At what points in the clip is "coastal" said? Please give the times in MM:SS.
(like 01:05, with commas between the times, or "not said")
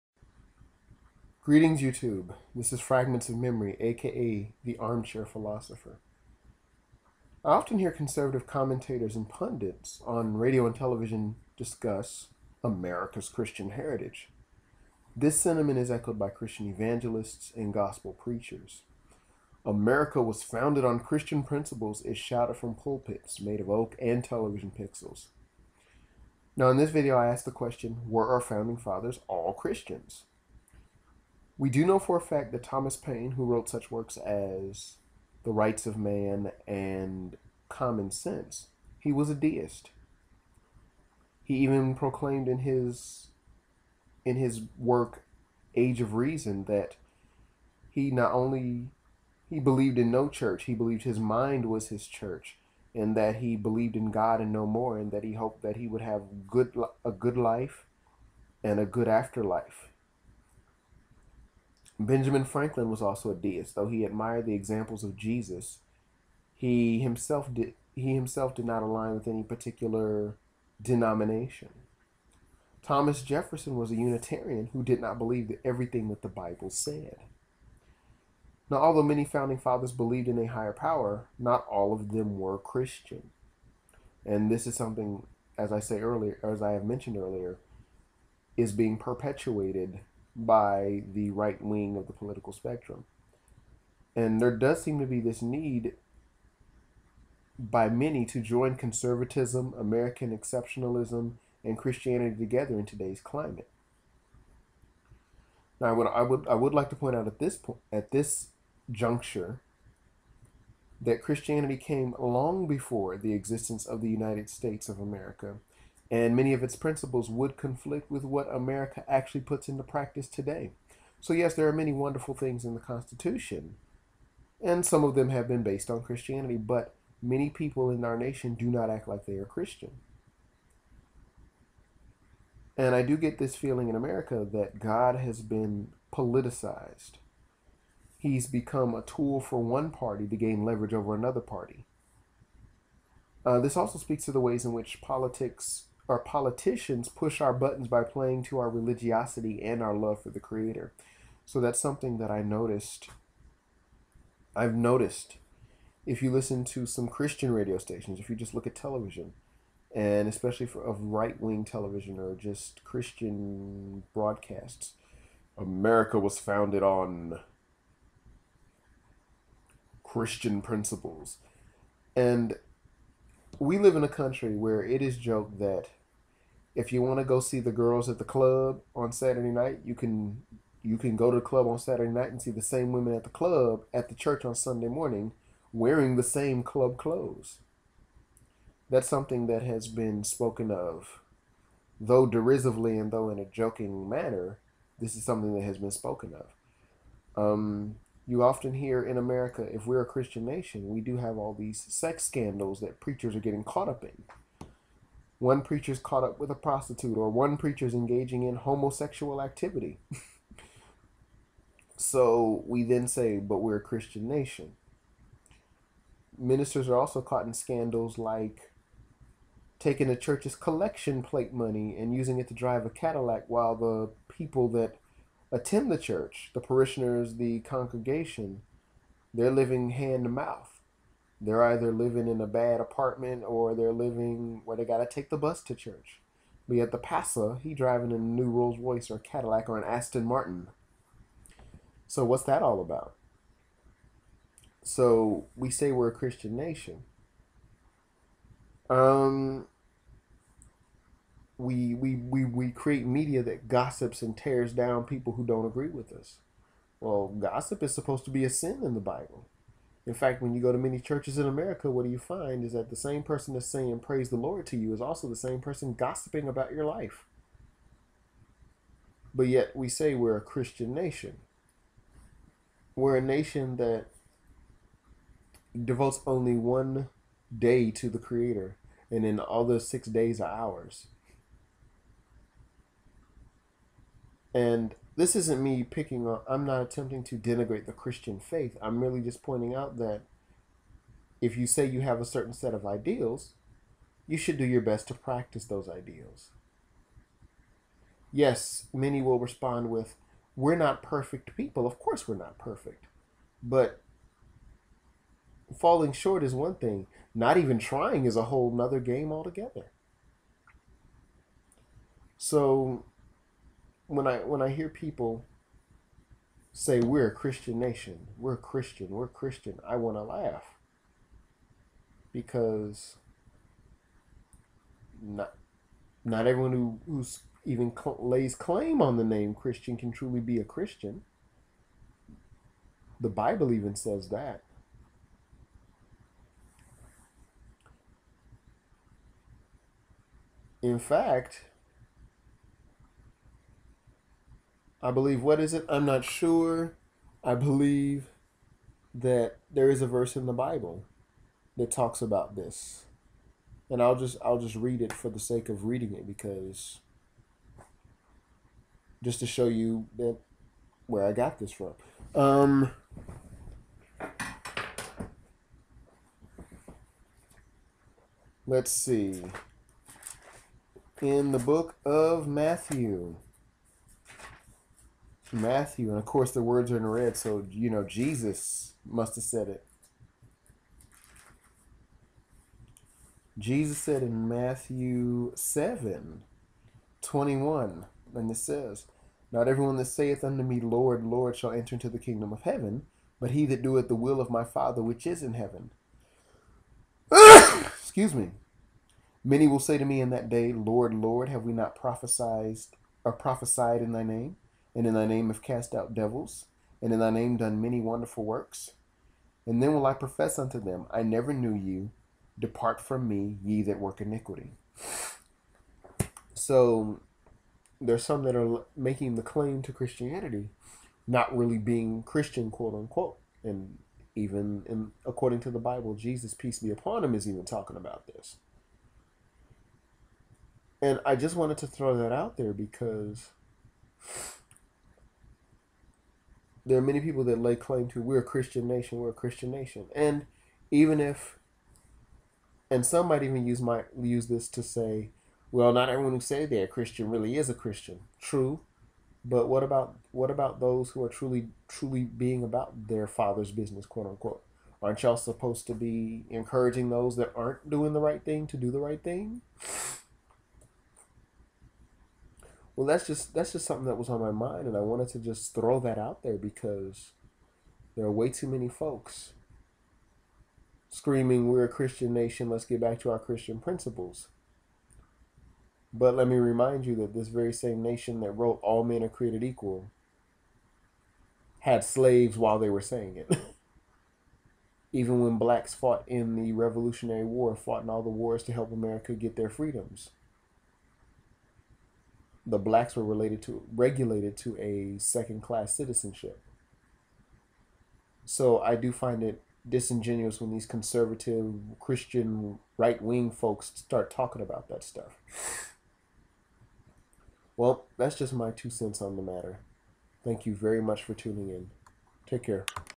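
not said.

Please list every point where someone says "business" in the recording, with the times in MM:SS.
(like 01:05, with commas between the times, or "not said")
07:33.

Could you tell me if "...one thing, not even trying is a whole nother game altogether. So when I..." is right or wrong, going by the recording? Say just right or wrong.
right.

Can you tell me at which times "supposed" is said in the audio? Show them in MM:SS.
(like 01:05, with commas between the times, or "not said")
04:17, 07:35.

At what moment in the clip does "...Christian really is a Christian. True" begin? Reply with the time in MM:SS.
07:26.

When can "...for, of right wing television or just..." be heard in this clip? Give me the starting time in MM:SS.
02:40.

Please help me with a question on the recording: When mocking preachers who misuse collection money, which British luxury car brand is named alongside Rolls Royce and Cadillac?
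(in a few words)
Aston Martin.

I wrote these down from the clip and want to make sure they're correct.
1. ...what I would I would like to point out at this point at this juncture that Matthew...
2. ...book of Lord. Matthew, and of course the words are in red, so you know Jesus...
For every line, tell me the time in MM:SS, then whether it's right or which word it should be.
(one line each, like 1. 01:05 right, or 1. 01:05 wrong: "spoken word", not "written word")
1. 01:45 wrong: "Christianity", not "Matthew"
2. 06:11 wrong: "Matthew", not "Lord".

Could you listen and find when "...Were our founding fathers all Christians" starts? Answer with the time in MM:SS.
00:28.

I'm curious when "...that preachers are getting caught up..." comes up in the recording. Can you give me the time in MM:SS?
03:22.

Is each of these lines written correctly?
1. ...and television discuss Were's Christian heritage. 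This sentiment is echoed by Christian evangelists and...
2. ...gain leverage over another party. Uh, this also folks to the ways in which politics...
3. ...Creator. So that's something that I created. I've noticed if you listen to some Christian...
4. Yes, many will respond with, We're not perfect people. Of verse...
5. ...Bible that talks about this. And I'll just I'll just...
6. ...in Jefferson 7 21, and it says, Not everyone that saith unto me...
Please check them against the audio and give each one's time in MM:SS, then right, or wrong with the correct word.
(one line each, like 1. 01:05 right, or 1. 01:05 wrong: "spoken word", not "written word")
1. 00:10 wrong: "America", not "Were"
2. 02:20 wrong: "speaks", not "folks"
3. 02:30 wrong: "noticed", not "created"
4. 04:58 wrong: "course", not "verse"
5. 05:50 right
6. 06:24 wrong: "Matthew", not "Jefferson".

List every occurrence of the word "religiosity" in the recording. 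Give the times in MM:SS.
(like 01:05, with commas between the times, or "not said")
02:28.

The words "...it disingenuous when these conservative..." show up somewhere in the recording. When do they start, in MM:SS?
08:19.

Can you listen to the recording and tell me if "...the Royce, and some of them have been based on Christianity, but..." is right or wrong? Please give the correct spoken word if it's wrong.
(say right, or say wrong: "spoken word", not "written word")
wrong: "Constitution", not "Royce".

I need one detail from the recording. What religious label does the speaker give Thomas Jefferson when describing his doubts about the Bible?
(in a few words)
Unitarian.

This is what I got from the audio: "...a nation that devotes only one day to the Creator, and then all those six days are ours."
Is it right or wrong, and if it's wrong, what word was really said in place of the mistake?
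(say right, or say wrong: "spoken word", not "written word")
right.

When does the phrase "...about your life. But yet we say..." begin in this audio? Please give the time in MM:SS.
04:26.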